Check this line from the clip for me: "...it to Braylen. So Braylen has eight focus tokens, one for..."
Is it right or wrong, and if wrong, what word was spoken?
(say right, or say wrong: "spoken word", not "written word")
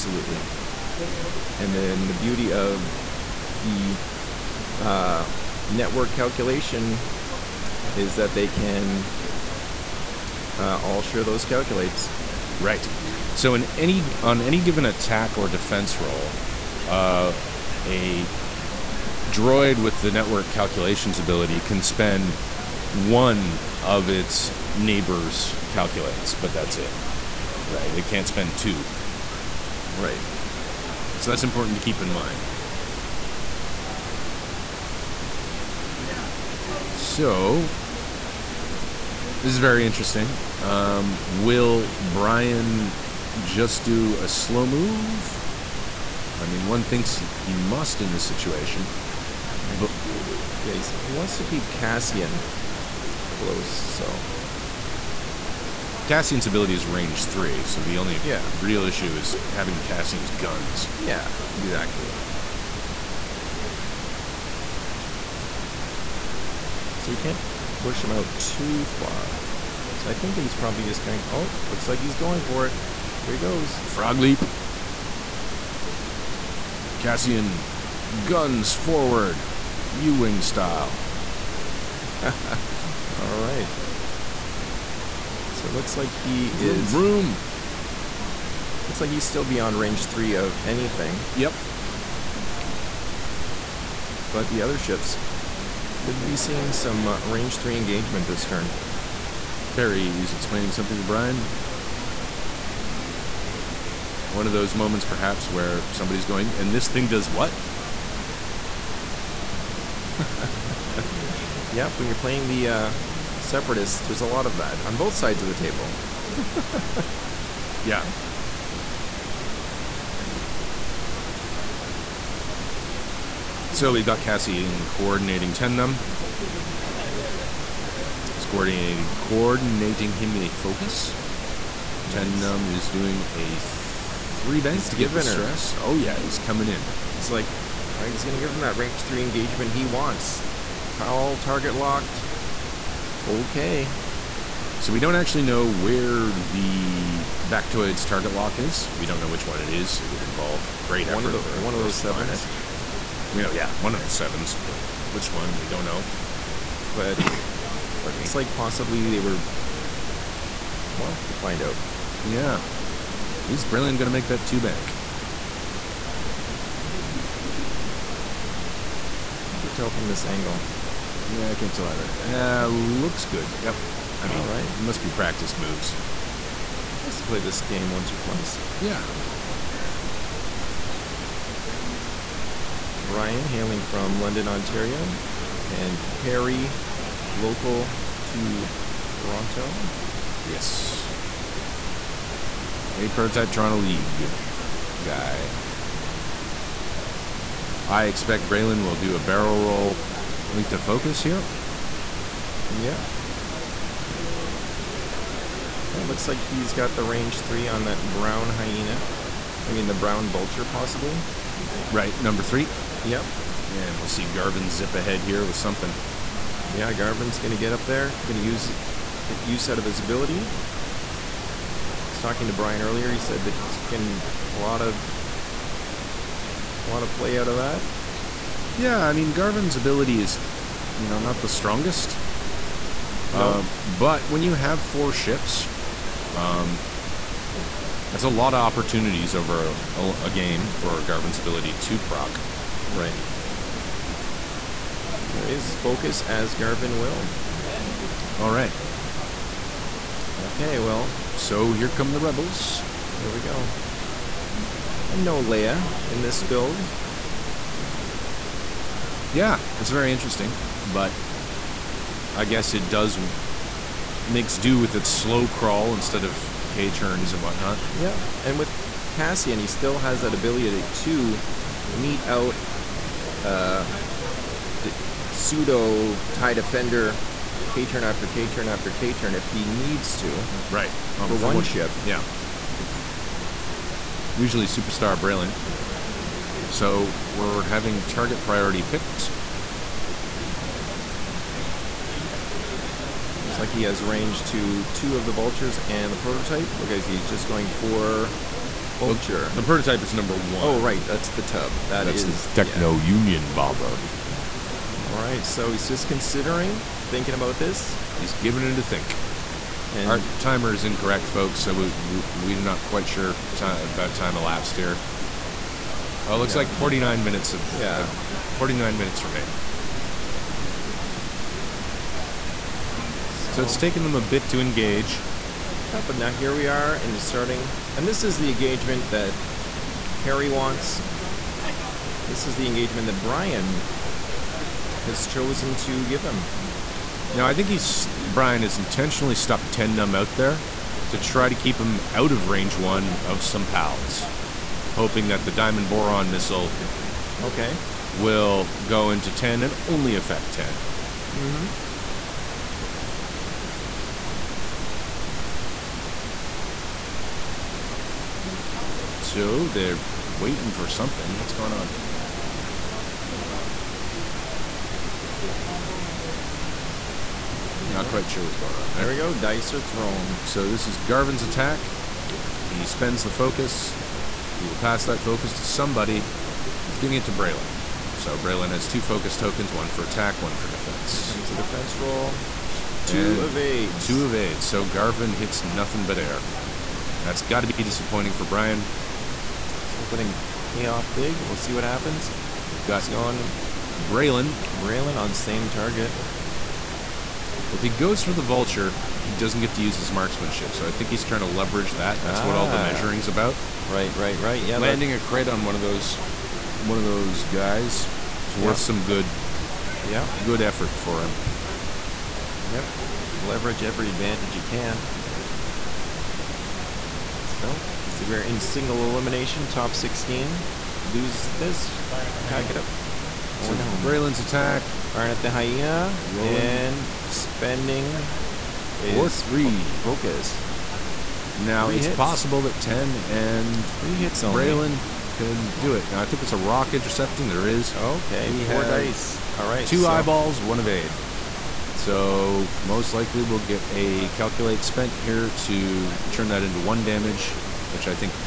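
wrong: "two", not "eight".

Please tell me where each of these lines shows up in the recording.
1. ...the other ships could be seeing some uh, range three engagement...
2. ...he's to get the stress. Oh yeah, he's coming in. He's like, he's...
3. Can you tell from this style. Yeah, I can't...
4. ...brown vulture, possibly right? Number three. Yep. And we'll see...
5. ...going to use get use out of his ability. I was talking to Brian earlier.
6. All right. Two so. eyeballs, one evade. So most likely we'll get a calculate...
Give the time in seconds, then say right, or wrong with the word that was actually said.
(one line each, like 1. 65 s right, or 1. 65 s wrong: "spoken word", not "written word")
1. 94 s right
2. 134 s right
3. 169 s wrong: "angle", not "style"
4. 209 s right
5. 218 s right
6. 439 s right.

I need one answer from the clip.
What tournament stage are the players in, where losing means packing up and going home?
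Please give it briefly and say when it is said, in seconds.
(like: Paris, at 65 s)
top 16, at 419 s.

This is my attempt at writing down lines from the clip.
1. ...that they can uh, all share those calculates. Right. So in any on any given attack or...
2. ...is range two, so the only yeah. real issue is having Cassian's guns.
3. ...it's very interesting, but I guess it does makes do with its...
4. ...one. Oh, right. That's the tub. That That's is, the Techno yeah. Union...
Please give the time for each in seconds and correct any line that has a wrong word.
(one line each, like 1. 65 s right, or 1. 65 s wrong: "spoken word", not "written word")
1. 8 s right
2. 56 s wrong: "three", not "two"
3. 259 s right
4. 300 s right.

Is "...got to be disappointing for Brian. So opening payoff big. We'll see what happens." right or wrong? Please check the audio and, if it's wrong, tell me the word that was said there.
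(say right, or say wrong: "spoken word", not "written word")
right.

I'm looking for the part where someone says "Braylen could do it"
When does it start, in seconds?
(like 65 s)
434 s.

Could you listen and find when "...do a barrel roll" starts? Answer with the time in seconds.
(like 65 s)
198 s.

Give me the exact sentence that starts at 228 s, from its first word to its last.
Yeah, I mean Garven's ability is, you know, not the strongest.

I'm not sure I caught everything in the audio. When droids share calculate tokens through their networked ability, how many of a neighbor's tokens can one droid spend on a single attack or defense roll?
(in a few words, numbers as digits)
1.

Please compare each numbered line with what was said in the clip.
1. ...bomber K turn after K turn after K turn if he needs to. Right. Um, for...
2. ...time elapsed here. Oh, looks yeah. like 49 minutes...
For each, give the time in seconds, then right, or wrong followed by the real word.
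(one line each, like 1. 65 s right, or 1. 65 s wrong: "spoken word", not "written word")
1. 276 s wrong: "defender", not "bomber"
2. 314 s right.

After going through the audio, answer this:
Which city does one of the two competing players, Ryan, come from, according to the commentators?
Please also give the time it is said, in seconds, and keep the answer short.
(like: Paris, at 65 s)
London, Ontario, at 184 s.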